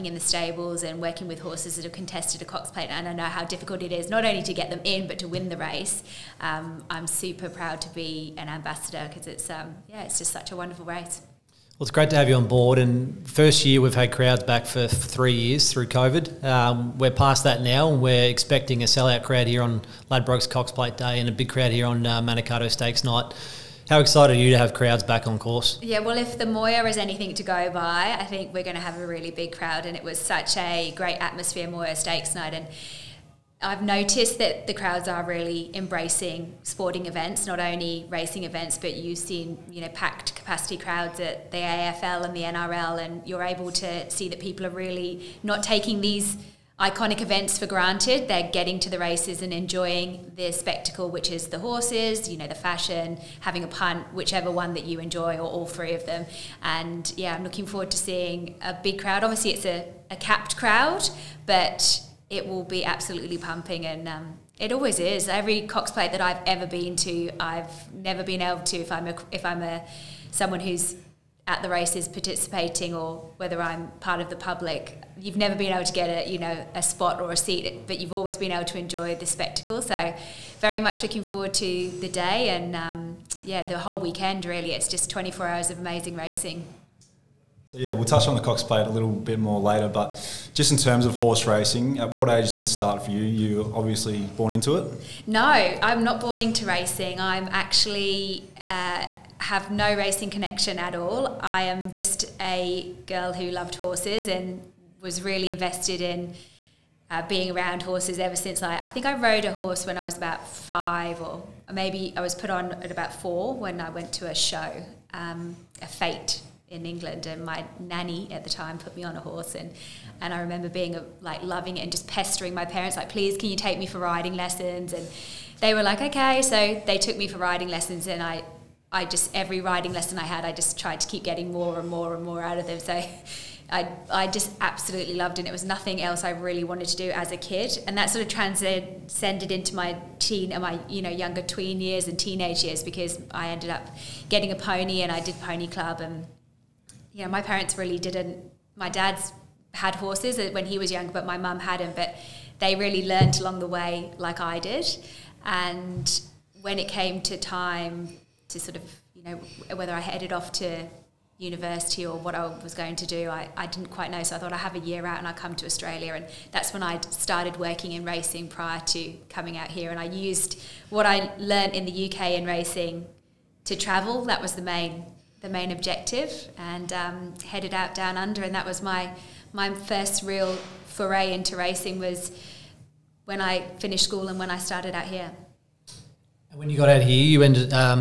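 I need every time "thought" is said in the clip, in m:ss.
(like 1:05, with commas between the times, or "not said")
2:44.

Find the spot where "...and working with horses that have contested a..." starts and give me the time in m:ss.
0:00.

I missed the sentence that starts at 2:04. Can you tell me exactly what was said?
And they were like, okay, so they took me for riding lessons, and I.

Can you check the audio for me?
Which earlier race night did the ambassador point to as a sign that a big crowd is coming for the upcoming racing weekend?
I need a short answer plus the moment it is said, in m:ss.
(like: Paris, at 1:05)
Moir Stakes Night, at 0:31.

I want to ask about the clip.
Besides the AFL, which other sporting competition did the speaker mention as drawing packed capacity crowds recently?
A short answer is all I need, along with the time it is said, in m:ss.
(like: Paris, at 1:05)
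NRL, at 0:42.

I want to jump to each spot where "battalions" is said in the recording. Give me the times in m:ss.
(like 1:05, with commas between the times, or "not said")
not said.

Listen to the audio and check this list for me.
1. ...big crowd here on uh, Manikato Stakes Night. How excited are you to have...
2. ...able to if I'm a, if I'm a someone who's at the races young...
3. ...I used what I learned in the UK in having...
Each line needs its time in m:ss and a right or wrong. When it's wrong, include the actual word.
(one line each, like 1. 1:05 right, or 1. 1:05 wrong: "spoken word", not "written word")
1. 0:21 right
2. 1:08 wrong: "participating", not "young"
3. 2:49 wrong: "racing", not "having".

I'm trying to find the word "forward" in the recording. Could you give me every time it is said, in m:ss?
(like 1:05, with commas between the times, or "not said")
0:57, 1:21.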